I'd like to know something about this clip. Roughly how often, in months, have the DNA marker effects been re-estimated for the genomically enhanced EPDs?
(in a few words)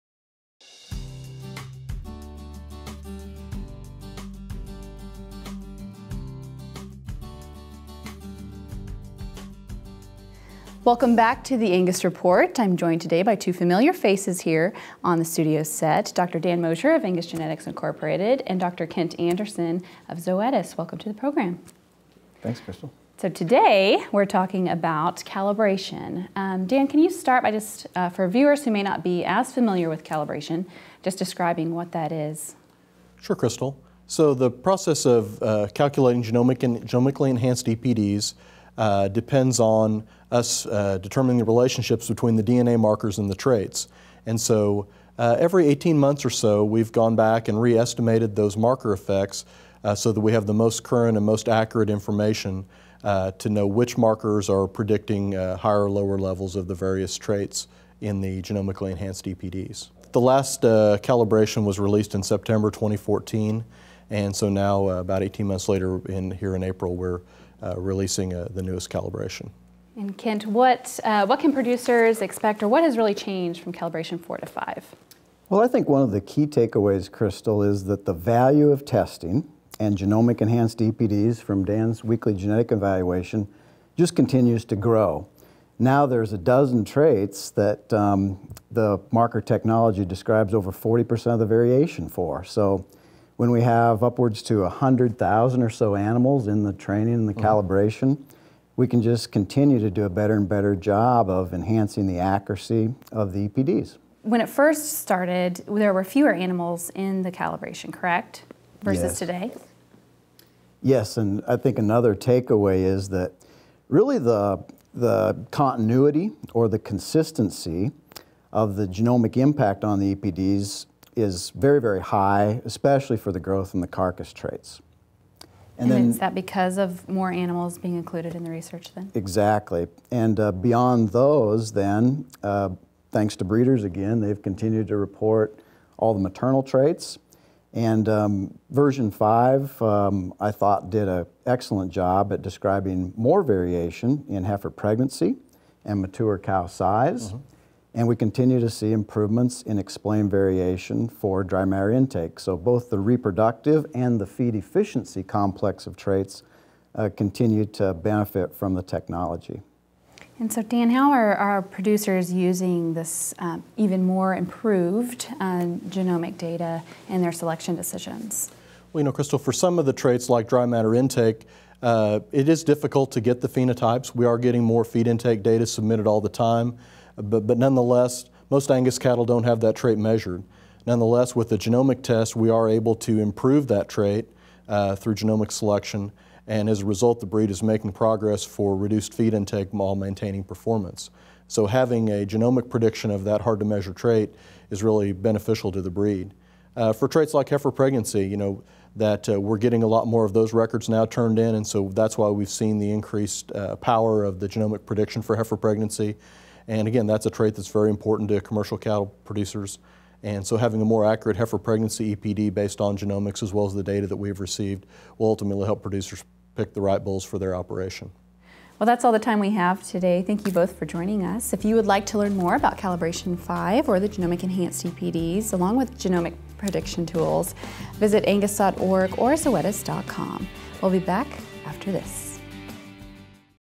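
18 months.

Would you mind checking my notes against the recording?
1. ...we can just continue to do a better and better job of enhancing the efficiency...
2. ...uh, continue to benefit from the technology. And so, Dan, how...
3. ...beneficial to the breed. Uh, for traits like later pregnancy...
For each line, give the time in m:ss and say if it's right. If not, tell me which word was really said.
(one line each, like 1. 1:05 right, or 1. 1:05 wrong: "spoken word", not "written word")
1. 1:38 wrong: "accuracy", not "efficiency"
2. 2:36 right
3. 3:15 wrong: "heifer", not "later".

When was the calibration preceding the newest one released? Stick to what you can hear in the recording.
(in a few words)
September 2014.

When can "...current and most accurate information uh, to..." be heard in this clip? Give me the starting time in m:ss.
0:50.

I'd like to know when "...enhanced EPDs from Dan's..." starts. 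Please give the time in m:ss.
1:20.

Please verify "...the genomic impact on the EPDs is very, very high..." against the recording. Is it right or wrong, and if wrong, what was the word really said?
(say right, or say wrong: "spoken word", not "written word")
right.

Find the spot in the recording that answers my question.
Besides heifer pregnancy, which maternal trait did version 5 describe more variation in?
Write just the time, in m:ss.
2:26.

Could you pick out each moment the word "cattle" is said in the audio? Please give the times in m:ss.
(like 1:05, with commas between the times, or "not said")
2:58, 3:28.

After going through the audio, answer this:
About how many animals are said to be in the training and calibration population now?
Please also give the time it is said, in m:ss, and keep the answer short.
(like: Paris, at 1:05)
100,000, at 1:34.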